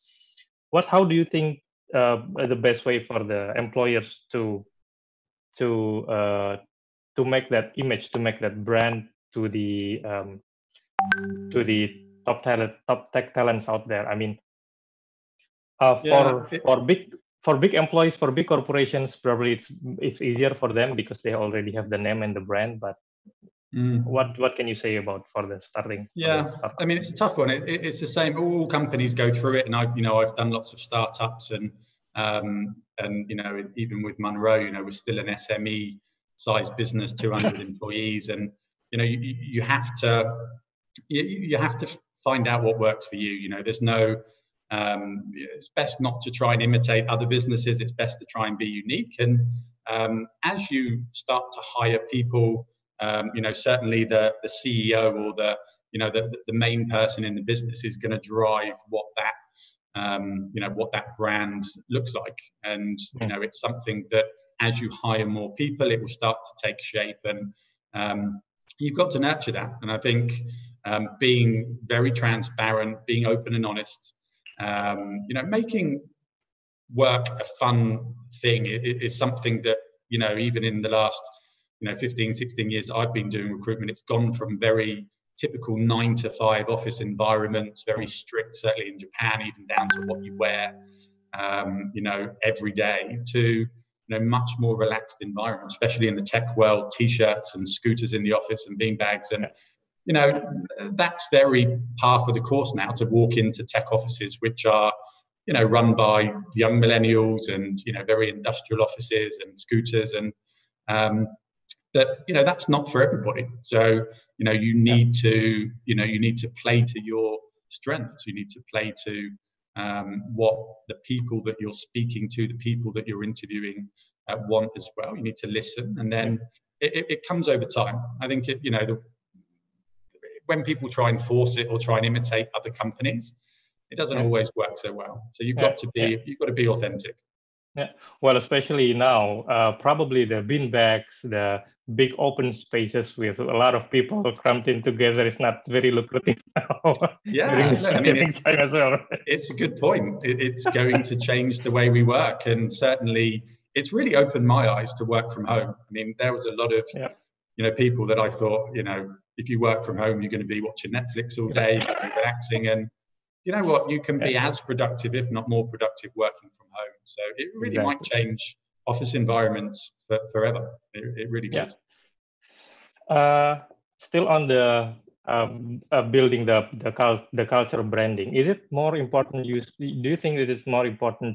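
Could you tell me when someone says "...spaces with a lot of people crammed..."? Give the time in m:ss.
2:22.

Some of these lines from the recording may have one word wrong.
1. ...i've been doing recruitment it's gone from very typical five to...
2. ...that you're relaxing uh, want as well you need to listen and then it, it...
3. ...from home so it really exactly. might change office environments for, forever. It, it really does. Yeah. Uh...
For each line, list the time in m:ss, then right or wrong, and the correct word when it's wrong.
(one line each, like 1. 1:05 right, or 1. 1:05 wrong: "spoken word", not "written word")
1. 1:22 wrong: "nine", not "five"
2. 2:02 wrong: "interviewing", not "relaxing"
3. 2:46 right.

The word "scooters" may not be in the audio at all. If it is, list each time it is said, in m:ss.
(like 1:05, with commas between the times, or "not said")
1:37, 1:49.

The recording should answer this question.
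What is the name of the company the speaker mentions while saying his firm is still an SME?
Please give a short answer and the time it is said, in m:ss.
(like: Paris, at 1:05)
Monroe, at 0:34.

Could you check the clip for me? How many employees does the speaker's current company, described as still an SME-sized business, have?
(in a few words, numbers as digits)
200.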